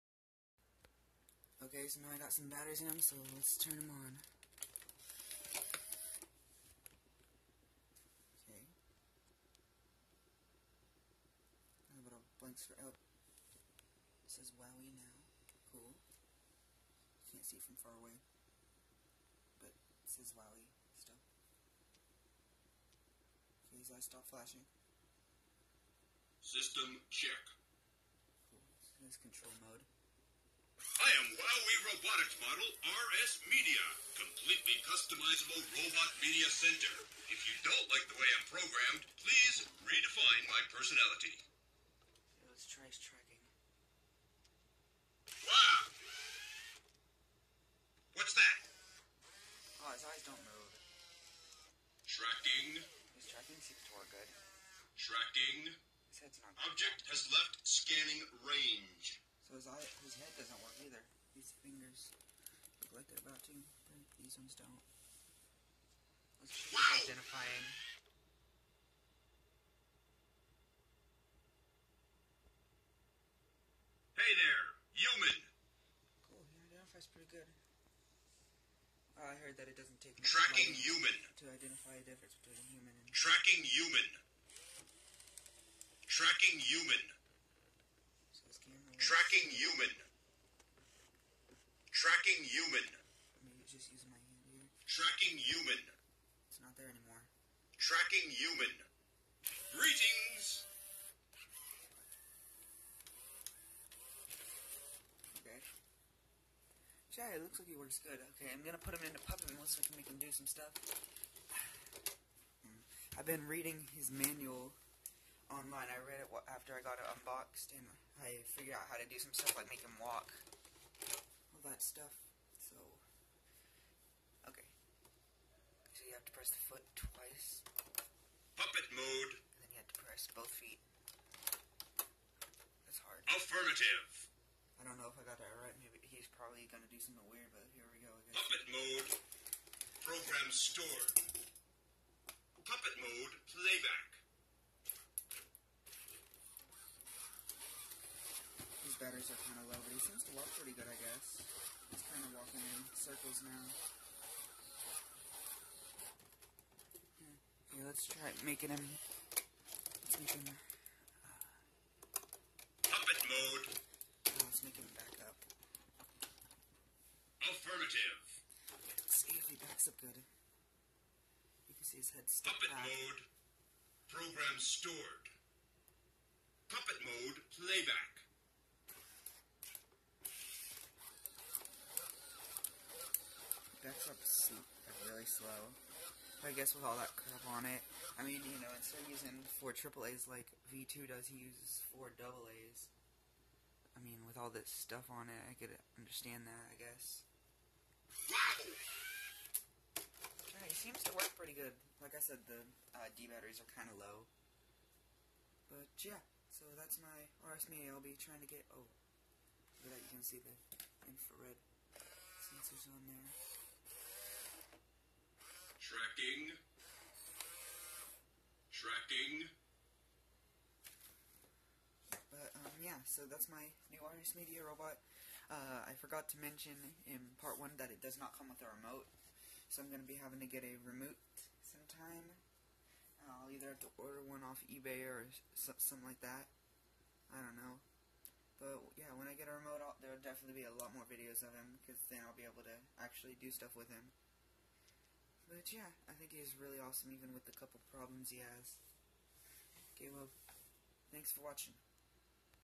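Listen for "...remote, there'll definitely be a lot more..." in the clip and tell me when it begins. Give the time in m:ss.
3:59.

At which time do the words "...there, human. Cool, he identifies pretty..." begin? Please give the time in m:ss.
1:14.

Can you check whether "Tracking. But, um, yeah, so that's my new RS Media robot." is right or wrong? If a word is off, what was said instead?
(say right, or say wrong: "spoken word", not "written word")
right.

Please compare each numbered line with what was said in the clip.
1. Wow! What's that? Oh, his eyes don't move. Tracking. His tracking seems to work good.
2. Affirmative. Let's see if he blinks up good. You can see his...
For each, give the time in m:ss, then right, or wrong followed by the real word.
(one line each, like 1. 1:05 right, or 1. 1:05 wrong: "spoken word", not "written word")
1. 0:45 right
2. 2:47 wrong: "backs", not "blinks".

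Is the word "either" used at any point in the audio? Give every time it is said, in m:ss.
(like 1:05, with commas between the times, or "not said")
1:00, 3:53.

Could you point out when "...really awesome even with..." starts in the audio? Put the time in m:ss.
4:06.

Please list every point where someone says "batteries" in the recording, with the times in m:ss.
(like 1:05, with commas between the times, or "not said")
0:02, 3:23.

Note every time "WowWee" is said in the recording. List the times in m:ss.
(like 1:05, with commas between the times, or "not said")
0:14, 0:20, 0:31.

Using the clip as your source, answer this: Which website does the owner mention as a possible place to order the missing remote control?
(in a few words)
eBay.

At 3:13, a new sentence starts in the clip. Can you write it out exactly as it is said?
I mean, with all this stuff on it, I could understand that, I guess.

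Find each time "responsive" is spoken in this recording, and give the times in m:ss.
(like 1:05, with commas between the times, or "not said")
not said.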